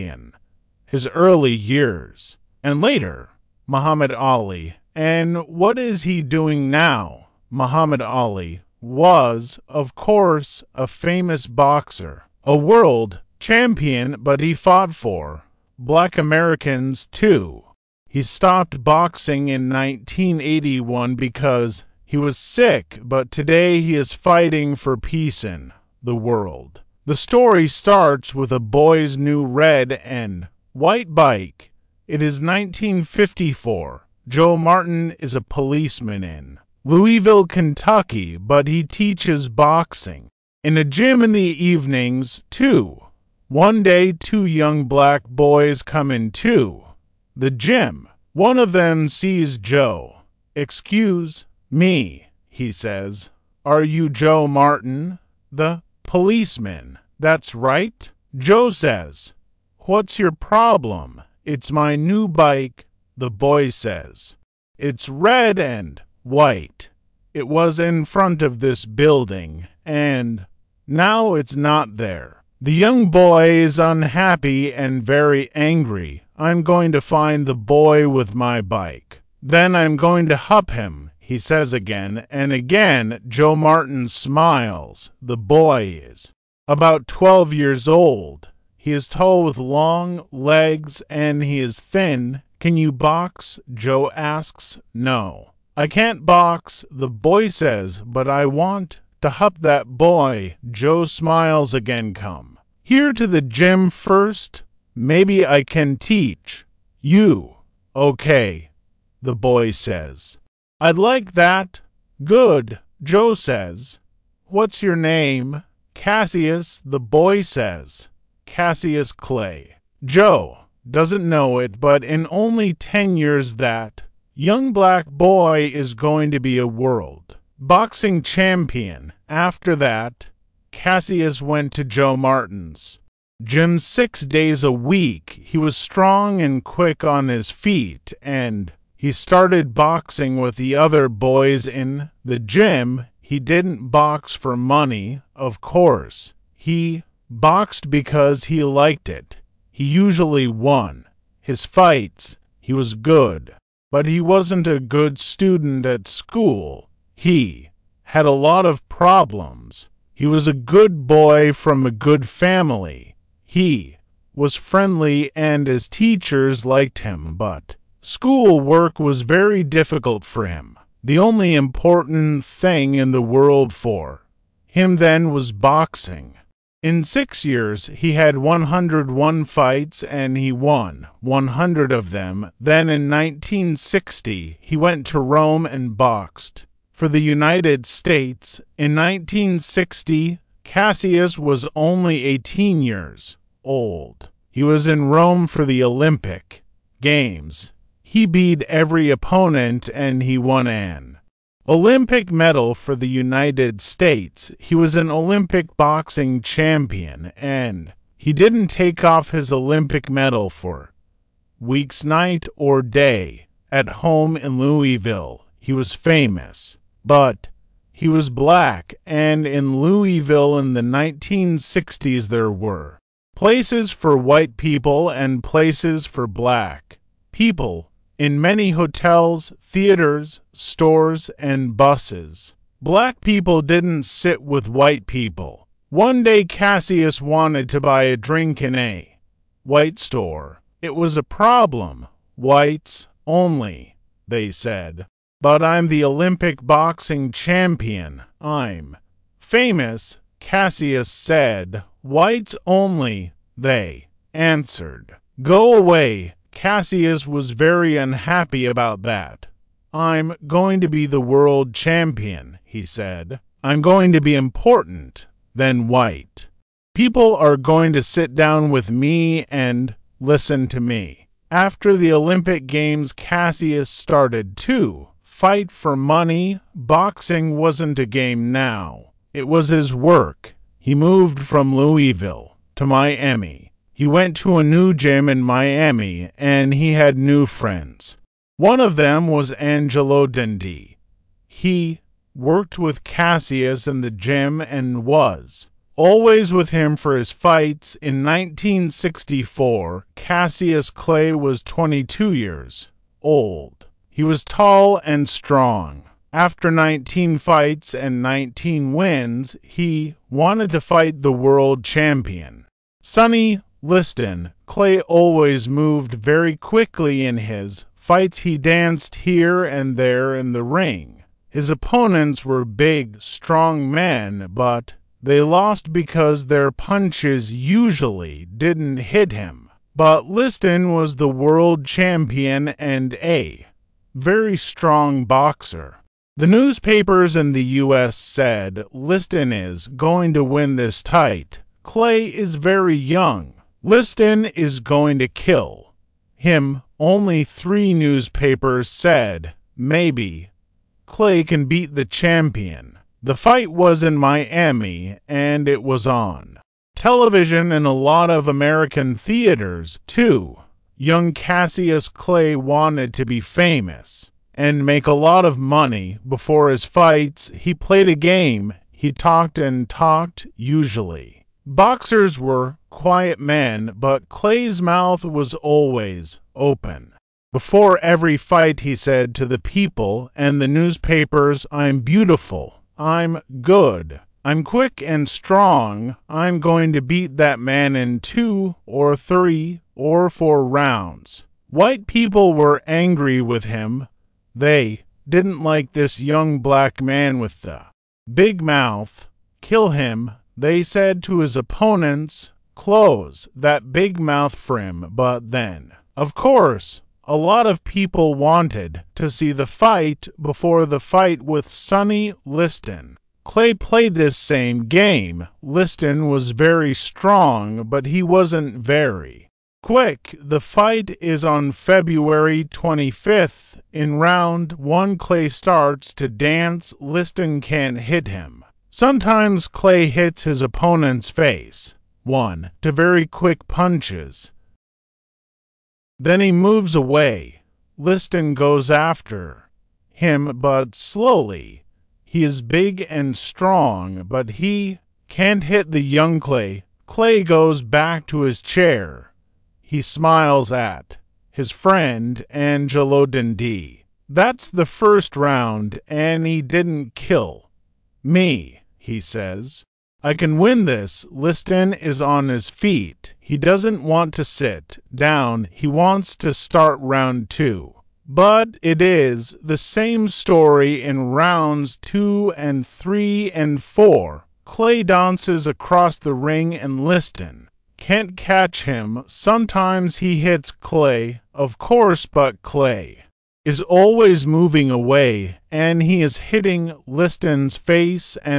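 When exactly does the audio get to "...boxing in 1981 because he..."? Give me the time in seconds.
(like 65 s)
18 s.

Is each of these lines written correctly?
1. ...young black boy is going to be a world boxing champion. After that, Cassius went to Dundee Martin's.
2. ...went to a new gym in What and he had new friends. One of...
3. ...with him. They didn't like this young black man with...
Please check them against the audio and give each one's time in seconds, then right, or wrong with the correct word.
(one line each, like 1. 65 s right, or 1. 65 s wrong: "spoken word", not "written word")
1. 124 s wrong: "Joe", not "Dundee"
2. 284 s wrong: "Miami", not "What"
3. 393 s right.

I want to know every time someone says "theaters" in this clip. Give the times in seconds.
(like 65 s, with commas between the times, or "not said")
229 s, 359 s.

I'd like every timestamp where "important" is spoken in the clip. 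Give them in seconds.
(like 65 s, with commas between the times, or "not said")
171 s, 264 s.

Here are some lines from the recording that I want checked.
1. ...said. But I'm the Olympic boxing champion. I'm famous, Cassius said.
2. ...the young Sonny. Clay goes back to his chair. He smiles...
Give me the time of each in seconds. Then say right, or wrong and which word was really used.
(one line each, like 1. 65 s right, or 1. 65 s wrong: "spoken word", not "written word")
1. 244 s right
2. 445 s wrong: "Clay", not "Sonny".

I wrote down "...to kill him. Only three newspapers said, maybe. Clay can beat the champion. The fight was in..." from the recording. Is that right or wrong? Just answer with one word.
right.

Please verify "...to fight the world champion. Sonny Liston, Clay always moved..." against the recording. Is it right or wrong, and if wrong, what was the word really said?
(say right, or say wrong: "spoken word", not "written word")
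right.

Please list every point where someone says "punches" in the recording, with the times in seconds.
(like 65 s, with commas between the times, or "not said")
326 s, 433 s.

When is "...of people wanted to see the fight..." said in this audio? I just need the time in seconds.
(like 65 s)
407 s.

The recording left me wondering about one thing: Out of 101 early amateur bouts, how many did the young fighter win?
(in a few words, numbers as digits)
100.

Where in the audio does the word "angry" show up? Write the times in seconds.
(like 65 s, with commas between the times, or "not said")
75 s, 392 s.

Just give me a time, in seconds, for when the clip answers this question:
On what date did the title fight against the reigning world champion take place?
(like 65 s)
421 s.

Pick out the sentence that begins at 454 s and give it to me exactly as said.
That's the first round, and he didn't kill me he says.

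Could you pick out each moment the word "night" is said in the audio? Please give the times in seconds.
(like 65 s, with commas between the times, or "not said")
212 s.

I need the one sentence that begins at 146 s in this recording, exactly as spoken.
He boxed because he liked it.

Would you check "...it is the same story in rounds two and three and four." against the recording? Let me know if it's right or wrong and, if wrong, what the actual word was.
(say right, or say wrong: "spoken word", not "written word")
right.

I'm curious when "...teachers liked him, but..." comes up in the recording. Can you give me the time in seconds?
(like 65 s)
165 s.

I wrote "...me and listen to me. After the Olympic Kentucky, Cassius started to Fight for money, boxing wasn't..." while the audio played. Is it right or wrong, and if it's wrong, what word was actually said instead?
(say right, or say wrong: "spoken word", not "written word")
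wrong: "Games", not "Kentucky".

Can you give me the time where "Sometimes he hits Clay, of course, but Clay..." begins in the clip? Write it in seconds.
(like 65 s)
479 s.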